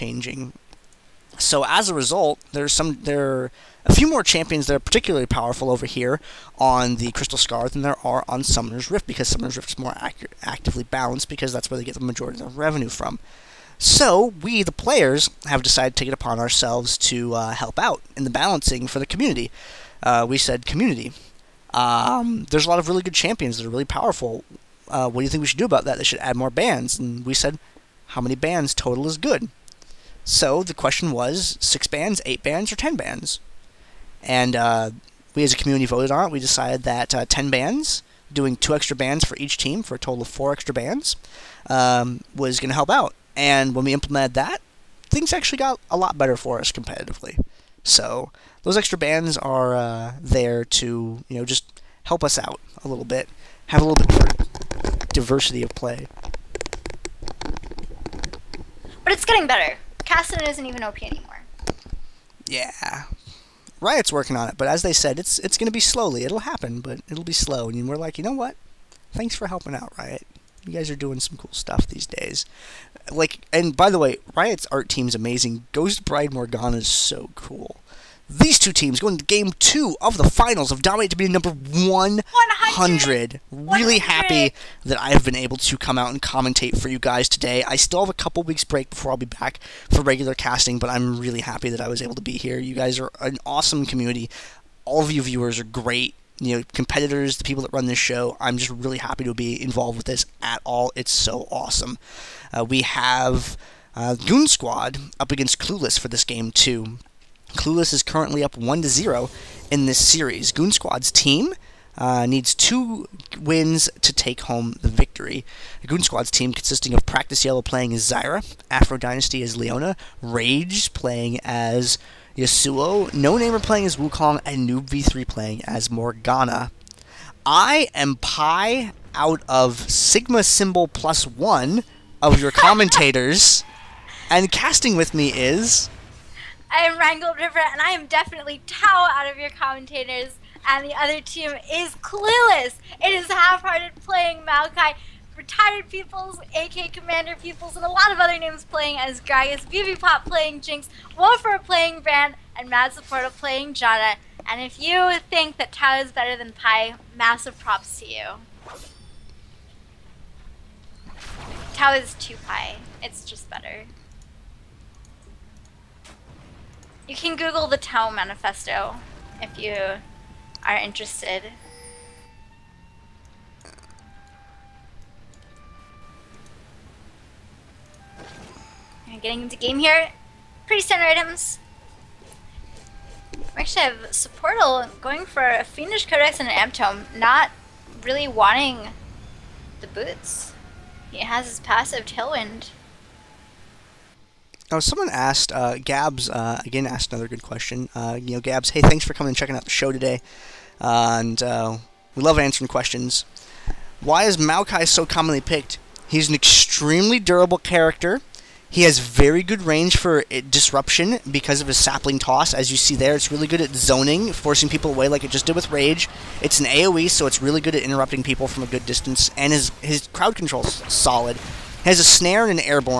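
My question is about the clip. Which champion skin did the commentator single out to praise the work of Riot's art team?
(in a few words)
Ghost Bride Morgana.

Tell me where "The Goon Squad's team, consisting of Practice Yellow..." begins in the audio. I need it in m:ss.
1:55.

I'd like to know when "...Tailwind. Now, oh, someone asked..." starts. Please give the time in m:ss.
3:12.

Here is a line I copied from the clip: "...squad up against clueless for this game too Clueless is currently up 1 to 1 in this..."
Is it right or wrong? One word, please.
wrong.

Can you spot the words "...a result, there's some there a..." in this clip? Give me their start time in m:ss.
0:01.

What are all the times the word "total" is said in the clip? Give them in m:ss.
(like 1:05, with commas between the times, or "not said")
0:28, 0:39.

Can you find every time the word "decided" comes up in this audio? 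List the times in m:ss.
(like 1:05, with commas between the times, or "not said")
0:15, 0:36.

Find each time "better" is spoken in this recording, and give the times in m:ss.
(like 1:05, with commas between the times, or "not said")
0:46, 0:59, 2:36, 2:43.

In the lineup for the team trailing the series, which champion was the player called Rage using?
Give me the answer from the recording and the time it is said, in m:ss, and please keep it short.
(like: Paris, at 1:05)
Yasuo, at 2:02.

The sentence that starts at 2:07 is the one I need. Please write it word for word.
I am Pi out of Sigma Symbol plus one of your commentators, and casting with me is.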